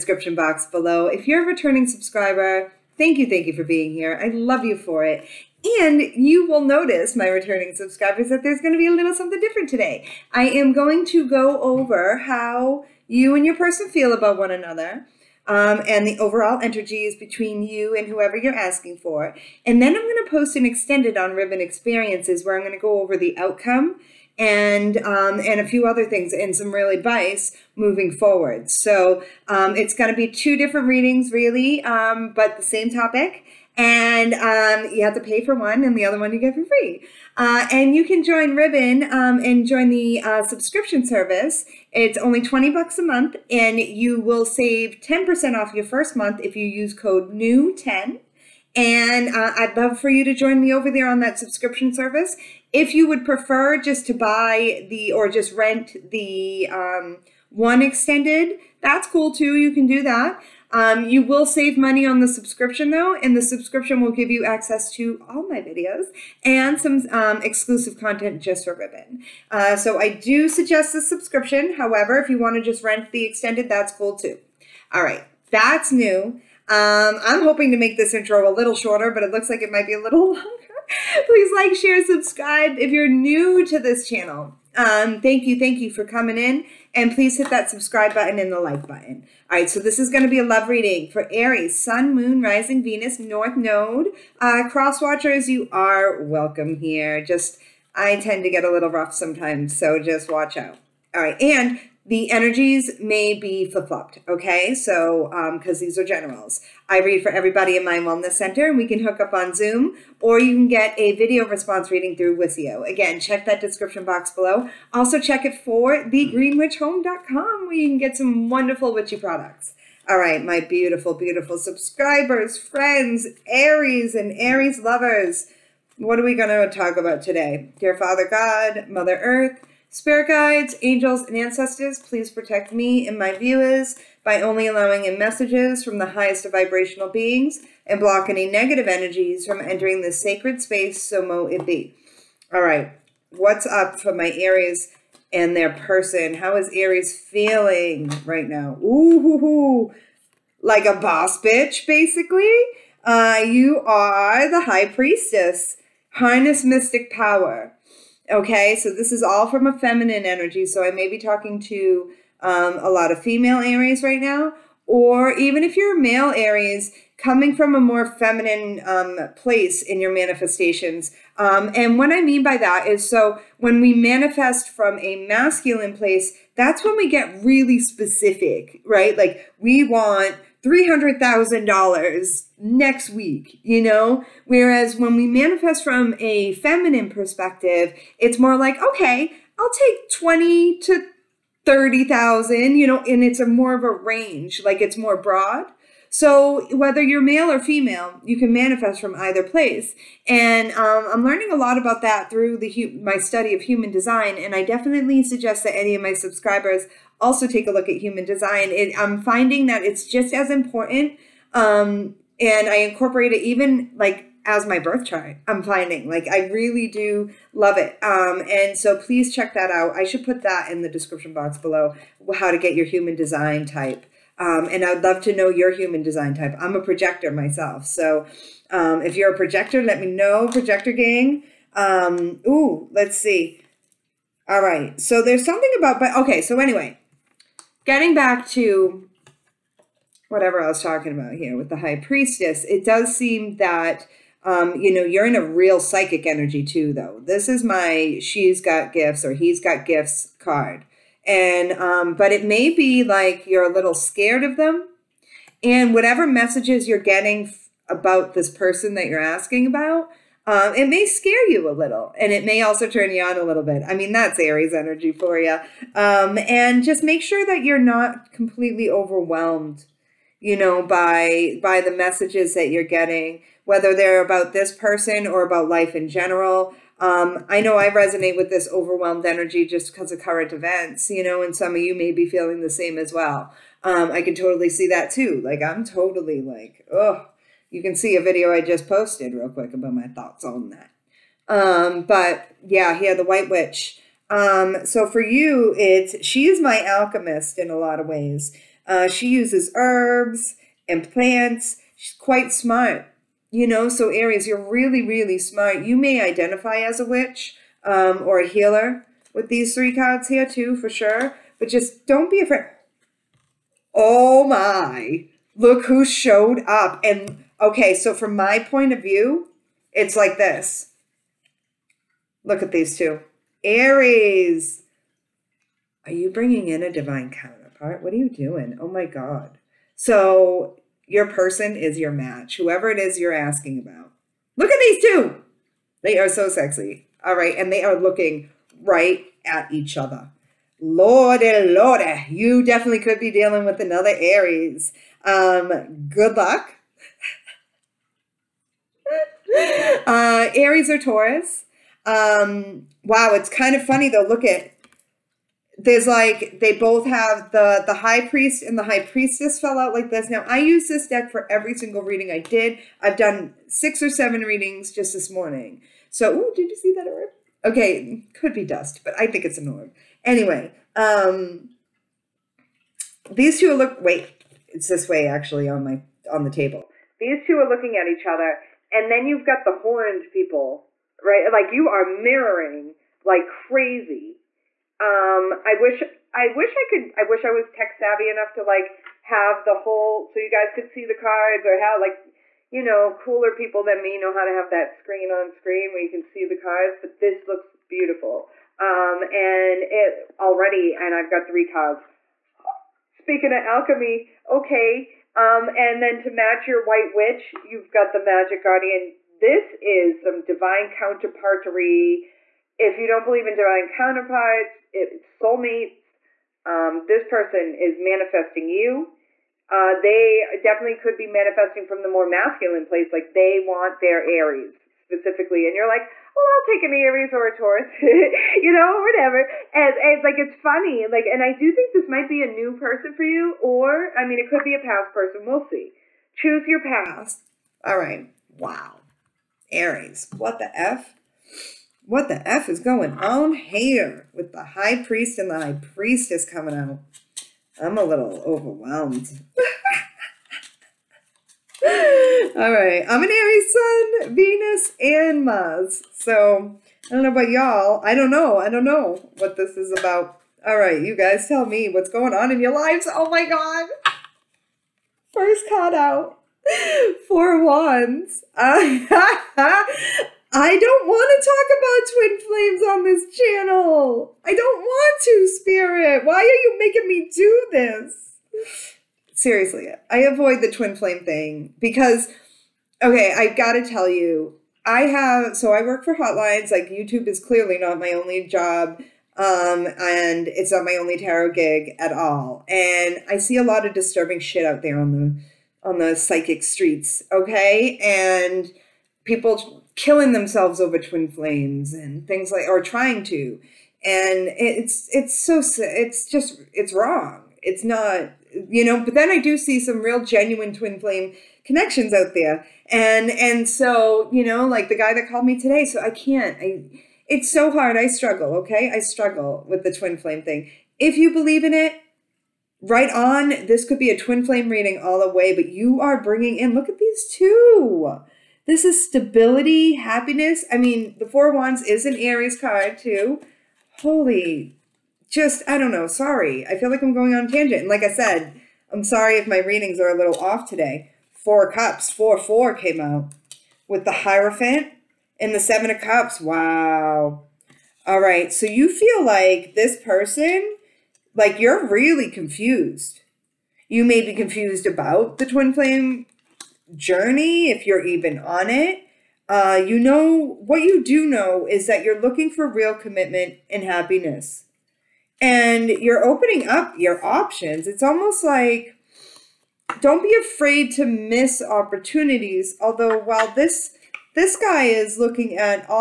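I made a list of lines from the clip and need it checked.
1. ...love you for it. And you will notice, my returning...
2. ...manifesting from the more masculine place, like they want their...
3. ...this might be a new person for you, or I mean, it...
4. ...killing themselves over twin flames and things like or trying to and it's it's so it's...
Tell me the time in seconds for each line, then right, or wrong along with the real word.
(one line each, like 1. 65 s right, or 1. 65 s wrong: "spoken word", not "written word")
1. 4 s right
2. 421 s right
3. 431 s right
4. 499 s right.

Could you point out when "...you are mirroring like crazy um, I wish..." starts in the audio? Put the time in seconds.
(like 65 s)
381 s.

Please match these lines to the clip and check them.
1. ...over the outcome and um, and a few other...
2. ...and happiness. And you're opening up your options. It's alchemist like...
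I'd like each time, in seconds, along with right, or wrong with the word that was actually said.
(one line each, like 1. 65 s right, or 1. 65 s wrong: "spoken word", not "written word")
1. 23 s right
2. 563 s wrong: "almost", not "alchemist".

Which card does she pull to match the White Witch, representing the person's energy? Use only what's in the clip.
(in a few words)
Magic Guardian.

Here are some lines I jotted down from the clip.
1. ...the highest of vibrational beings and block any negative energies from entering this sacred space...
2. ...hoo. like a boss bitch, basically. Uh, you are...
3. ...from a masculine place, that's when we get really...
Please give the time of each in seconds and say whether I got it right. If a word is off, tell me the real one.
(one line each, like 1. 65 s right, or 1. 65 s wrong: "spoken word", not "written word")
1. 135 s right
2. 149 s right
3. 174 s right.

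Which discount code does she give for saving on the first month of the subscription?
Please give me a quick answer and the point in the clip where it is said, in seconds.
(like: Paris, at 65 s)
new 10, at 47 s.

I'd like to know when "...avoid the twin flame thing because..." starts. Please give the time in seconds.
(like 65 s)
480 s.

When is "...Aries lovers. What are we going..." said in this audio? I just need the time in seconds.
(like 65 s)
124 s.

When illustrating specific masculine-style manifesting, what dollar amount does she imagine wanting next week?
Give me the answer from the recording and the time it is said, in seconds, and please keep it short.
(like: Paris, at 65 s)
$300,000, at 180 s.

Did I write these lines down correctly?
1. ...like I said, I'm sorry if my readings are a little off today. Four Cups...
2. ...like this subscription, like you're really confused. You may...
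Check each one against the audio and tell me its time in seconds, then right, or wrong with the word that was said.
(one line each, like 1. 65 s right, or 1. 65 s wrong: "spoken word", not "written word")
1. 537 s right
2. 549 s wrong: "person", not "subscription".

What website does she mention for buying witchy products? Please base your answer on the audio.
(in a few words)
thegreenwitchhome.com.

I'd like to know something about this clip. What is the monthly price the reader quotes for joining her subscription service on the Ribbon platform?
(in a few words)
$20.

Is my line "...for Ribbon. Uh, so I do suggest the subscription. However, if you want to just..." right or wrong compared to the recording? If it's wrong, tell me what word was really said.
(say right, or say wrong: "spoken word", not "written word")
right.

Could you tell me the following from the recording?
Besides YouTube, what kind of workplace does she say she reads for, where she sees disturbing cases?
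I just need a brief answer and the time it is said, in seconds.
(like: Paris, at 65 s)
Hotlines, at 486 s.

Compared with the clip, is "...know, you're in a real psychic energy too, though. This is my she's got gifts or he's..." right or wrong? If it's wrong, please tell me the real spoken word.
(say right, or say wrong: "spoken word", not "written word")
right.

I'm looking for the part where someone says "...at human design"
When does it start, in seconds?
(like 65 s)
207 s.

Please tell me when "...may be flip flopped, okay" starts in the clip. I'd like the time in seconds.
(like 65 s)
102 s.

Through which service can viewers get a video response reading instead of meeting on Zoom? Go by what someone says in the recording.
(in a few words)
Wisio.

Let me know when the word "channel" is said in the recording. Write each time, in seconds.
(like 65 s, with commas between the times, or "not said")
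84 s, 473 s.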